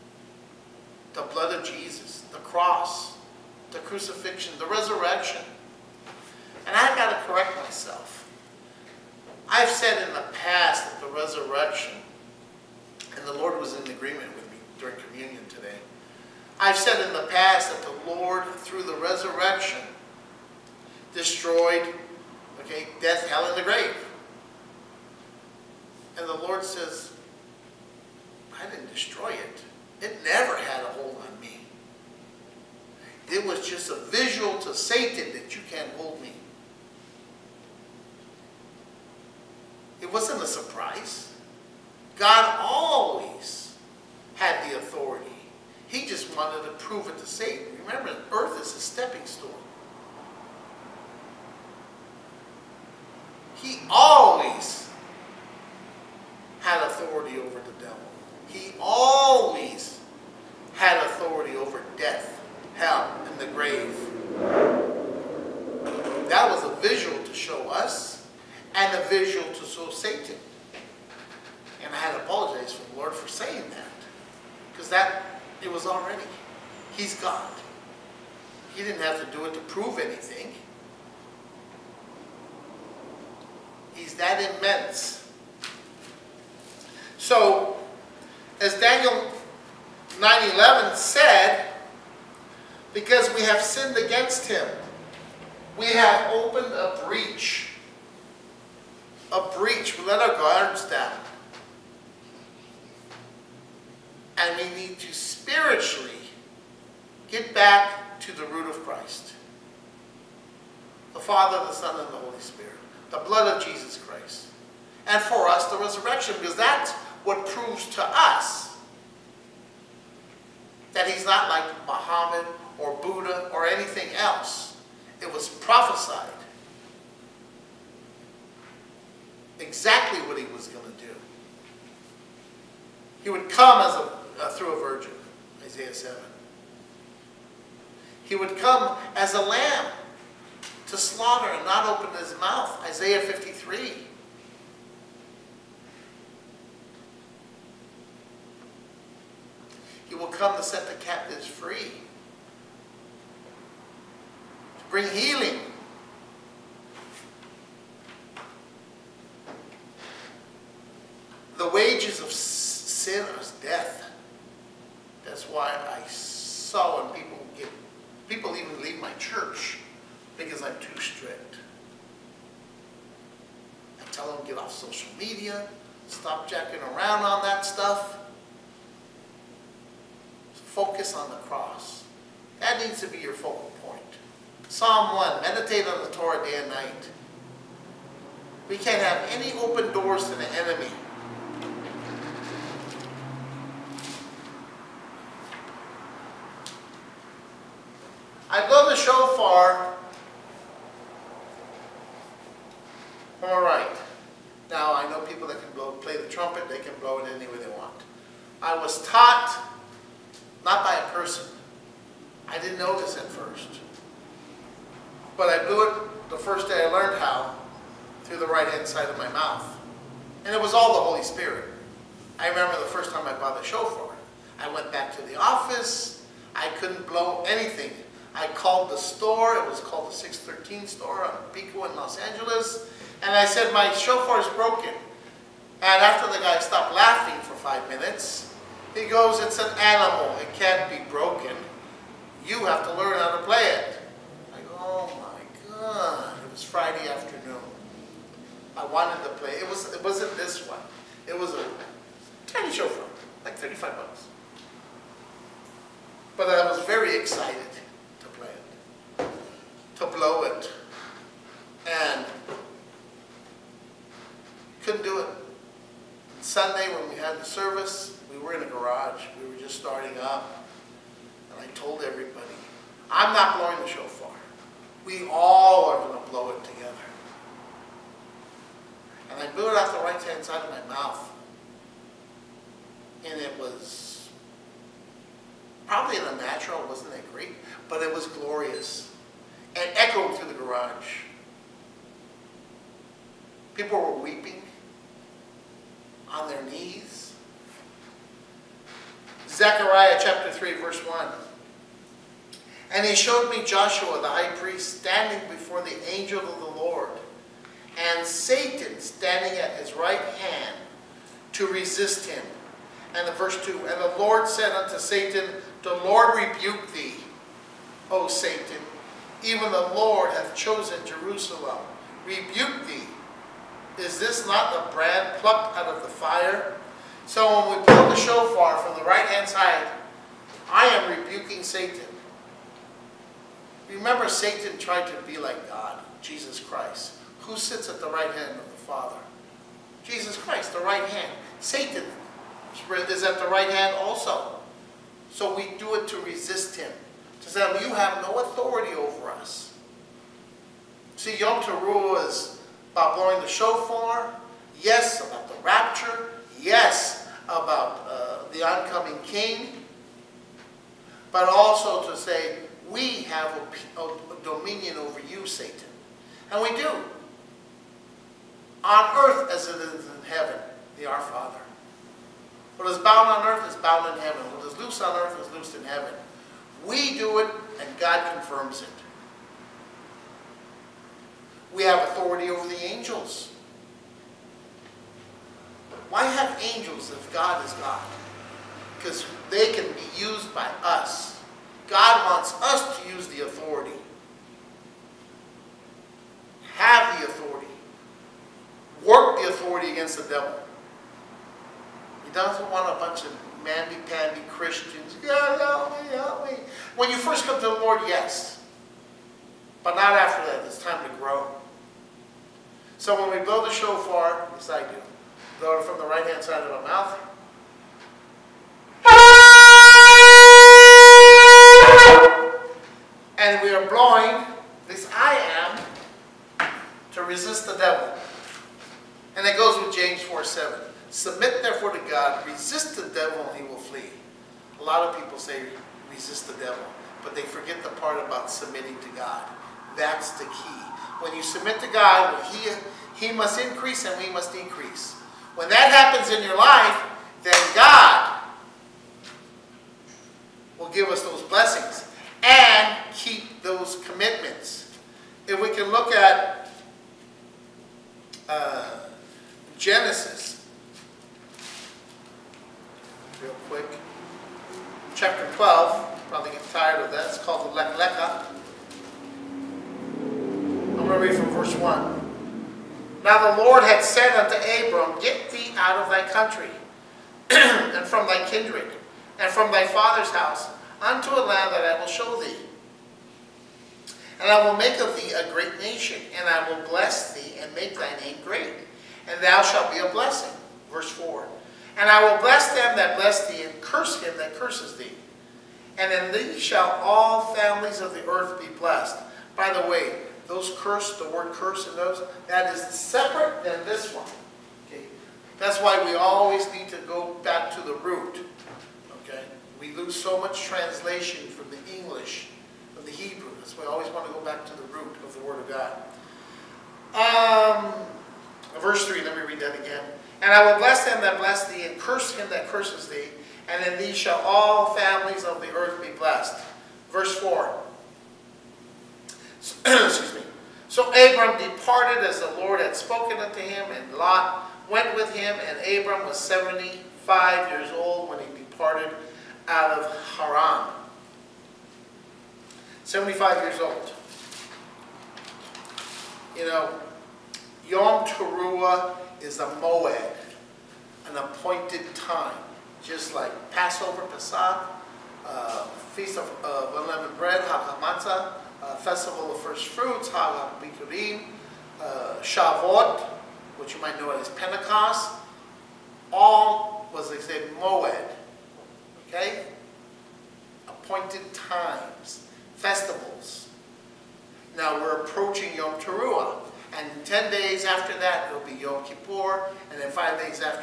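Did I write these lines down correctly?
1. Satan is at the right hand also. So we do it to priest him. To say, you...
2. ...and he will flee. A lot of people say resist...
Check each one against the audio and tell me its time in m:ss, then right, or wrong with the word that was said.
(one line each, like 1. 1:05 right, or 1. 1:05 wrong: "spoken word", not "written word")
1. 5:41 wrong: "resist", not "priest"
2. 7:13 right.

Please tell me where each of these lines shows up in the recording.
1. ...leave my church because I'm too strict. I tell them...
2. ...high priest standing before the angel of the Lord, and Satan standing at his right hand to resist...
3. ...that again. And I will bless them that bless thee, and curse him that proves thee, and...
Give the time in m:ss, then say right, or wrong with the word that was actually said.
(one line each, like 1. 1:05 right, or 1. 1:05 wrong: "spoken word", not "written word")
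1. 2:48 right
2. 5:04 right
3. 8:39 wrong: "curses", not "proves".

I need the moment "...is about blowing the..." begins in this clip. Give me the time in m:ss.
5:52.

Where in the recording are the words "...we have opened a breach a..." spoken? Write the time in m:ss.
1:35.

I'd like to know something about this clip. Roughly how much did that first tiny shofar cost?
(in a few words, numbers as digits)
$35.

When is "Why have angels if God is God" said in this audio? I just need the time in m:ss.
6:26.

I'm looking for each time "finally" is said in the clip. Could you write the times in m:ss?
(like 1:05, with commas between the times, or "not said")
not said.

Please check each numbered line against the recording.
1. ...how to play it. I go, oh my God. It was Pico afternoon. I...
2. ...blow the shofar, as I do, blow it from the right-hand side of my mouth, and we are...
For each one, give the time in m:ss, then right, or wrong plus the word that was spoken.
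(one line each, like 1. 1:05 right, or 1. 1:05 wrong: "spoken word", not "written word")
1. 4:03 wrong: "Friday", not "Pico"
2. 6:53 right.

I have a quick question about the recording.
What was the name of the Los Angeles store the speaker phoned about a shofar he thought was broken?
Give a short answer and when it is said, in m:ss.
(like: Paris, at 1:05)
613 store, at 3:50.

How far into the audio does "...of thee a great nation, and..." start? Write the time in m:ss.
8:05.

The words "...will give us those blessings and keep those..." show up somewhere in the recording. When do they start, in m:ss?
7:30.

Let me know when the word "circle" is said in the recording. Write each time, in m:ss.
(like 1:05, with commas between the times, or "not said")
not said.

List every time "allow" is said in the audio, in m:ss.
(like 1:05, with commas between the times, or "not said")
not said.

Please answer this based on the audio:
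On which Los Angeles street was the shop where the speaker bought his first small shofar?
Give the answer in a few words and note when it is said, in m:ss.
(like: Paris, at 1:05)
Pico, at 3:51.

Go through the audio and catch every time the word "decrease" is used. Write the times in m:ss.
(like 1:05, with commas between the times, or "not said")
7:24.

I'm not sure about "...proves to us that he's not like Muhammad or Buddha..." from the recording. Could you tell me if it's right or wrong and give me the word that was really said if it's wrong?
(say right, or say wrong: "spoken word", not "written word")
right.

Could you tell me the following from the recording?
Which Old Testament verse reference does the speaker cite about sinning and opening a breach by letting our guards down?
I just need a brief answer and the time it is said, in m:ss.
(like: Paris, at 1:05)
Daniel 9:11, at 1:28.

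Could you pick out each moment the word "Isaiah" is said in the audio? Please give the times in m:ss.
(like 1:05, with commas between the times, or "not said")
2:15, 2:22.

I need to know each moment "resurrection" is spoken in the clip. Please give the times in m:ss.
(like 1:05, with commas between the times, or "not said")
0:04, 0:11, 0:18, 1:55.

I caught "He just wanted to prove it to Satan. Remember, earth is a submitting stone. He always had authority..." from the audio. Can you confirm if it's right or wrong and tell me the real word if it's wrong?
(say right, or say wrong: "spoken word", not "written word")
wrong: "stepping", not "submitting".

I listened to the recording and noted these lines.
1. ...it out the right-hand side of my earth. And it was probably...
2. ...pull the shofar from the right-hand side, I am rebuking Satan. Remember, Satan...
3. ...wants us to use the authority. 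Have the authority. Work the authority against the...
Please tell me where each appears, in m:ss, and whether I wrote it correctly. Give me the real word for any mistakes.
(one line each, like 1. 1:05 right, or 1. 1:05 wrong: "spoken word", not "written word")
1. 4:39 wrong: "mouth", not "earth"
2. 5:27 right
3. 6:32 right.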